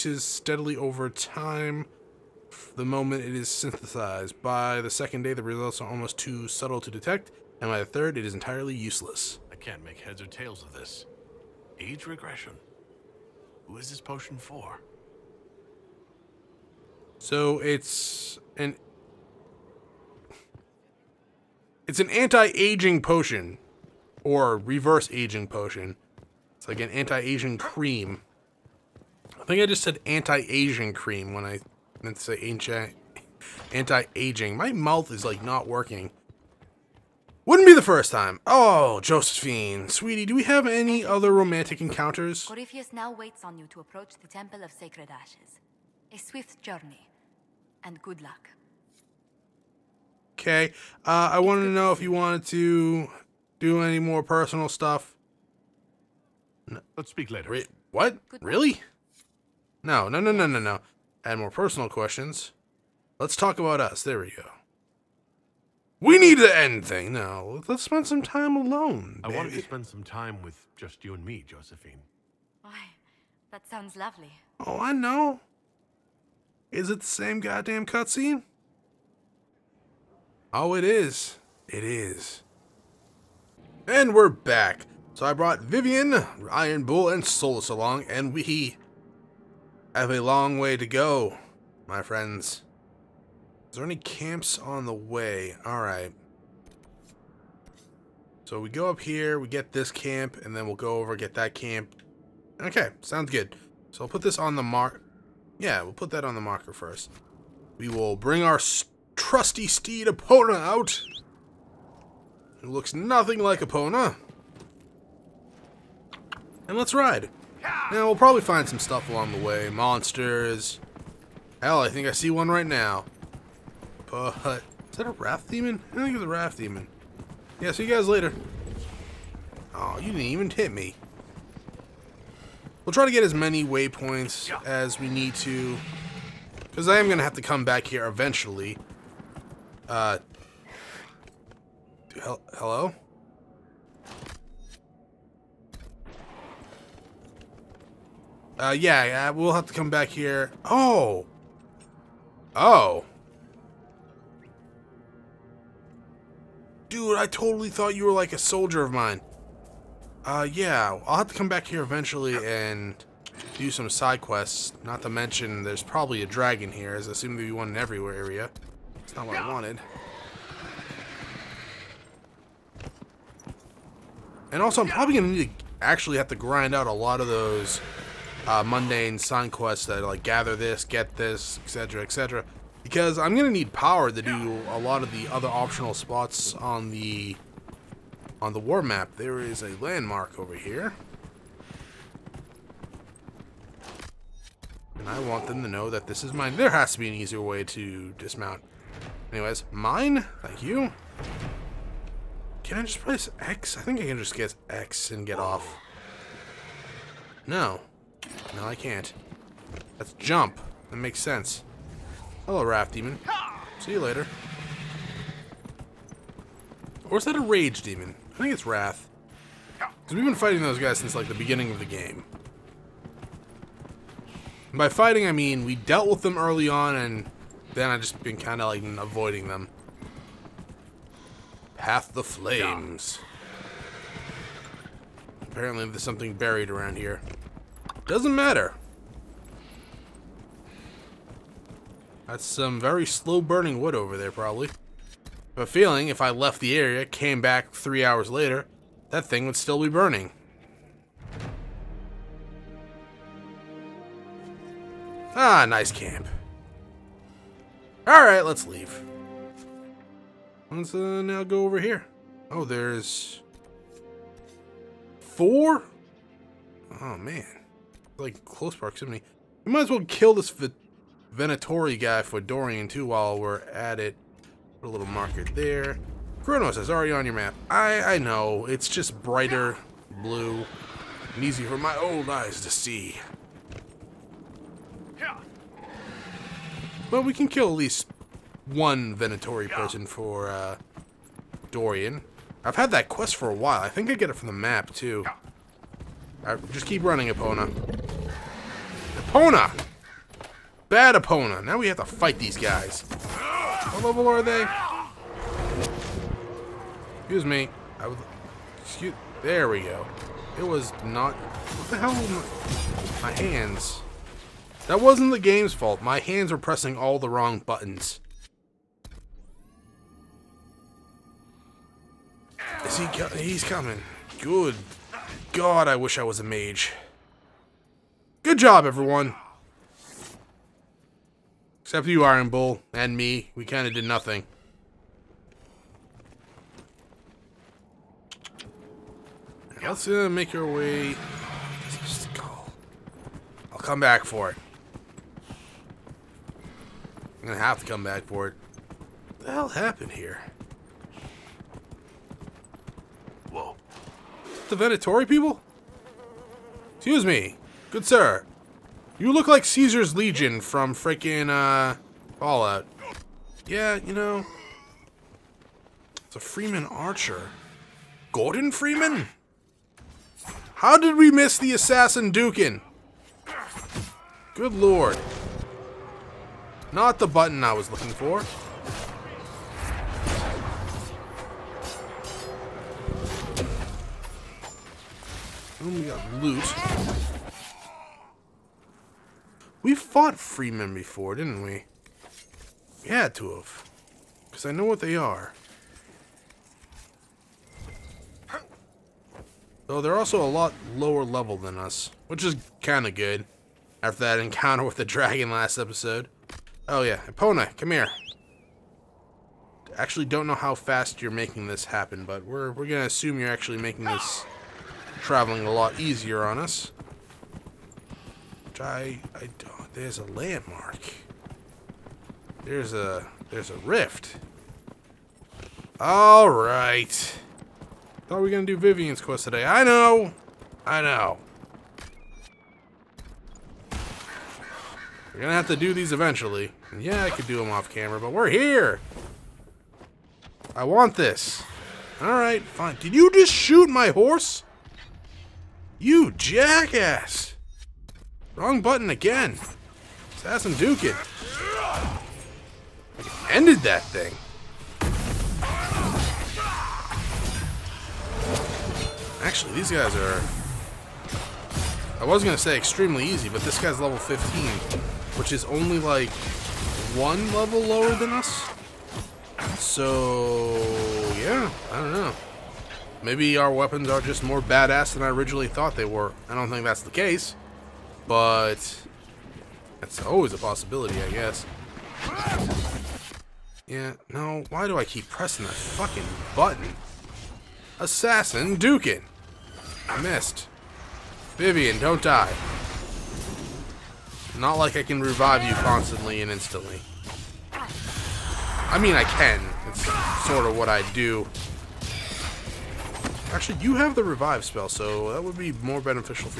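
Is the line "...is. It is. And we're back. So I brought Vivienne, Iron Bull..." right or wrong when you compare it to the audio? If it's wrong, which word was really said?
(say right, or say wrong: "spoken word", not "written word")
right.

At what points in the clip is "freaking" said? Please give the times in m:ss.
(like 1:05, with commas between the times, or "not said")
6:00.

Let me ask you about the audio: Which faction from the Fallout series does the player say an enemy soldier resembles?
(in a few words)
Caesar's Legion.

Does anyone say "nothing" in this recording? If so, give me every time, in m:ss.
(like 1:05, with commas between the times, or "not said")
1:52, 5:34.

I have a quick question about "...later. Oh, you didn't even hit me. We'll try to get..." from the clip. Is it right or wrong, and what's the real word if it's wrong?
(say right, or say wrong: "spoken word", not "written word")
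right.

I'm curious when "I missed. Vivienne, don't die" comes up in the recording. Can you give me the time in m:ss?
8:10.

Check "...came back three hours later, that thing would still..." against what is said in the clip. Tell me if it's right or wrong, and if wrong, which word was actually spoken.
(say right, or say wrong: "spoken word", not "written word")
right.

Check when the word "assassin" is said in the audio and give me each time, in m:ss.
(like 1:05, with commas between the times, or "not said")
6:11, 7:30, 8:07.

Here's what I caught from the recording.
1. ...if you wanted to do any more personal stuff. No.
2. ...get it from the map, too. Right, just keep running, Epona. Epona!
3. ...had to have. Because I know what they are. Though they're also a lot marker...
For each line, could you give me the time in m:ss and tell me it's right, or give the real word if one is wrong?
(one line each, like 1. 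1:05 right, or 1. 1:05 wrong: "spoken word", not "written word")
1. 0:51 right
2. 4:54 right
3. 6:33 wrong: "lower", not "marker".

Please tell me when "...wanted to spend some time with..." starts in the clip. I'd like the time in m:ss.
1:09.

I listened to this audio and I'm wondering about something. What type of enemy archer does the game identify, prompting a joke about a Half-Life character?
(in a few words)
Freeman Archer.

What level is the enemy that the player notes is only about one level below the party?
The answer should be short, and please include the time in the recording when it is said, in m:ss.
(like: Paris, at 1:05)
15, at 7:44.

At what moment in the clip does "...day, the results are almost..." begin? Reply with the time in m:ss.
0:05.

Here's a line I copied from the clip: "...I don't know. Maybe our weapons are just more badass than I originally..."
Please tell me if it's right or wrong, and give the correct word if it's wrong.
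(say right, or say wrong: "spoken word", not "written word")
right.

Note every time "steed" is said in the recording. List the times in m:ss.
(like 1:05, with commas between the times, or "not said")
1:49.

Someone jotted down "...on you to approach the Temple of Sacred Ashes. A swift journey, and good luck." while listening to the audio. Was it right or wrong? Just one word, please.
right.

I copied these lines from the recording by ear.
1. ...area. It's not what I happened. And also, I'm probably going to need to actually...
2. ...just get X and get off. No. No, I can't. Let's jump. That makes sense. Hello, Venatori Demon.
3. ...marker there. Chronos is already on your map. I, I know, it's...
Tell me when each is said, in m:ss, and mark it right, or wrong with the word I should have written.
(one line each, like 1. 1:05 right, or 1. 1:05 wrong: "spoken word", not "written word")
1. 2:47 wrong: "wanted", not "happened"
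2. 3:24 wrong: "Wrath", not "Venatori"
3. 4:35 right.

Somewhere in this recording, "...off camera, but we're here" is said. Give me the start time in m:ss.
7:17.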